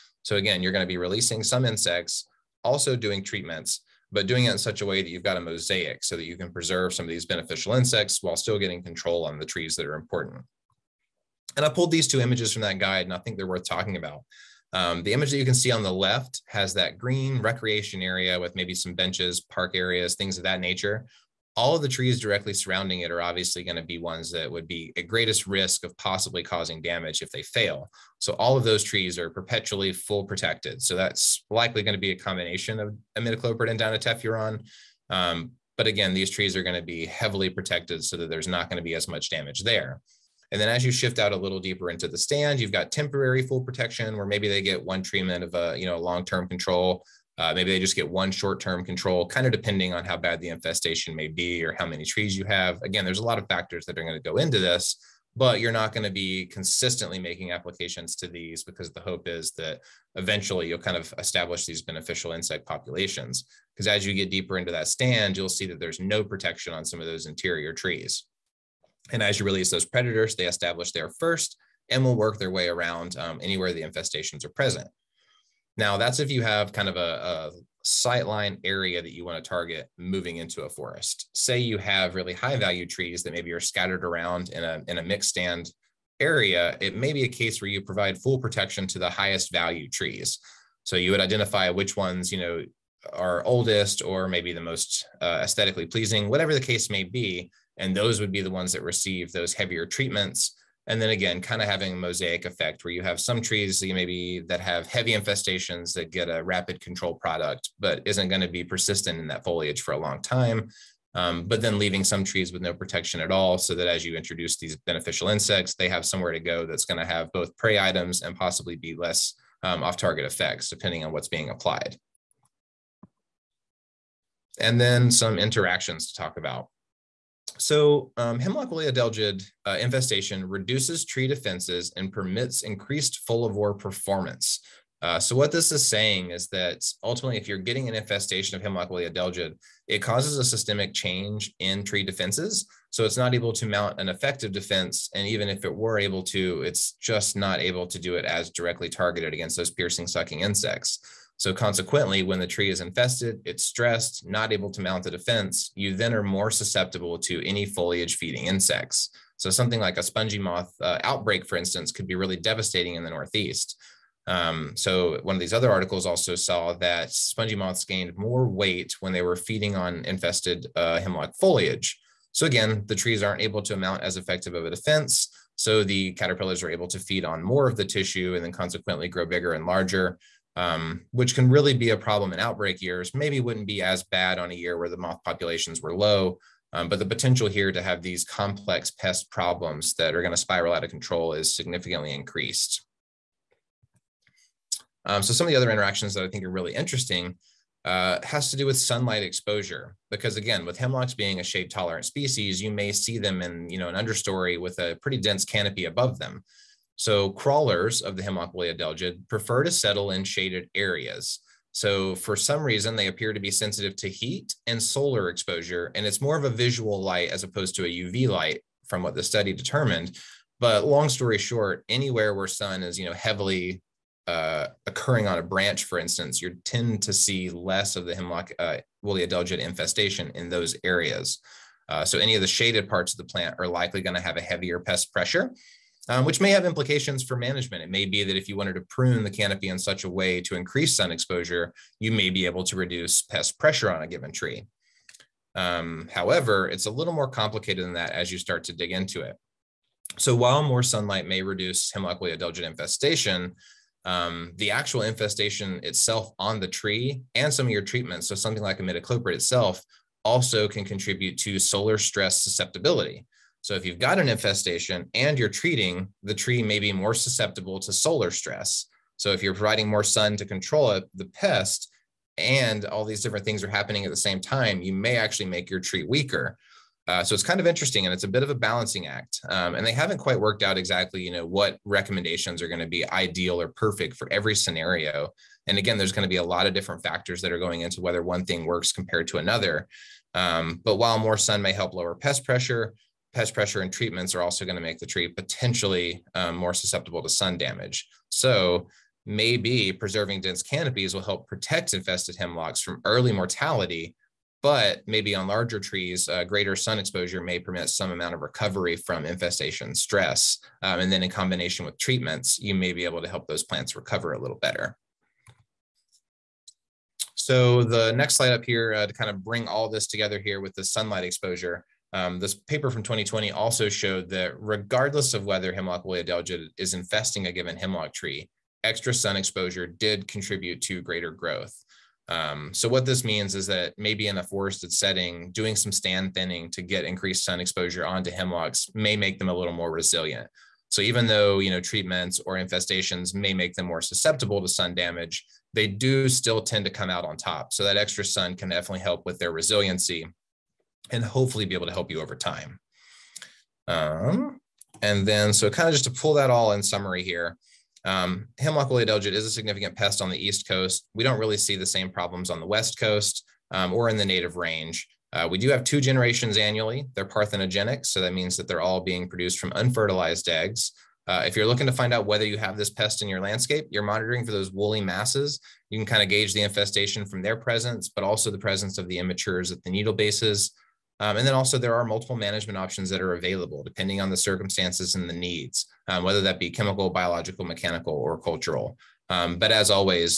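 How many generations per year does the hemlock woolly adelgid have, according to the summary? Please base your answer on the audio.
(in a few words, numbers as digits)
2.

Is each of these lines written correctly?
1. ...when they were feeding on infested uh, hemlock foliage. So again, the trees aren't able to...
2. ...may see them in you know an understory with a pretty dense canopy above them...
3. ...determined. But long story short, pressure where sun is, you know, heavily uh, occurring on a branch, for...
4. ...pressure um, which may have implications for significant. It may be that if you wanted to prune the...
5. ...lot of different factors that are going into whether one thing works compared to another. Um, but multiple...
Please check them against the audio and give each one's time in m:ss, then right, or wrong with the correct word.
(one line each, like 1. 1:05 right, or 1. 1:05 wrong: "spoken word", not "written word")
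1. 2:49 right
2. 3:22 right
3. 3:39 wrong: "anywhere", not "pressure"
4. 3:55 wrong: "management", not "significant"
5. 4:46 wrong: "while", not "multiple".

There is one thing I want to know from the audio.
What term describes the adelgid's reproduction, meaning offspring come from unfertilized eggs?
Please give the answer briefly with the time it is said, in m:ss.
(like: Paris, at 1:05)
parthenogenic, at 6:07.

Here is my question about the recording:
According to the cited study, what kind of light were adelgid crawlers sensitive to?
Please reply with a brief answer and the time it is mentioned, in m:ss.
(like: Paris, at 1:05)
visual light, at 3:36.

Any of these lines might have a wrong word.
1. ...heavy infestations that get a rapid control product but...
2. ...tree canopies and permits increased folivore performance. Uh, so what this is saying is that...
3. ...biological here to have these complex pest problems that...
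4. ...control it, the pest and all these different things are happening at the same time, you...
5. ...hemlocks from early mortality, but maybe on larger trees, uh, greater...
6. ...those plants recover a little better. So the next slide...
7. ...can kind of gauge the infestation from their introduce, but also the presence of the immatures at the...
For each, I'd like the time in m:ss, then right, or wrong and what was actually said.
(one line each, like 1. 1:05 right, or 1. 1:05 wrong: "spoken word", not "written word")
1. 1:44 right
2. 2:11 wrong: "defenses", not "canopies"
3. 3:07 wrong: "potential", not "biological"
4. 4:30 right
5. 5:02 right
6. 5:13 right
7. 6:15 wrong: "presence", not "introduce".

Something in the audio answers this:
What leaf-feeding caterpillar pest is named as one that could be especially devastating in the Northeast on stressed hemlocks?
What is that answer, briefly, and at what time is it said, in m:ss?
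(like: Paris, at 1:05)
spongy moth, at 2:40.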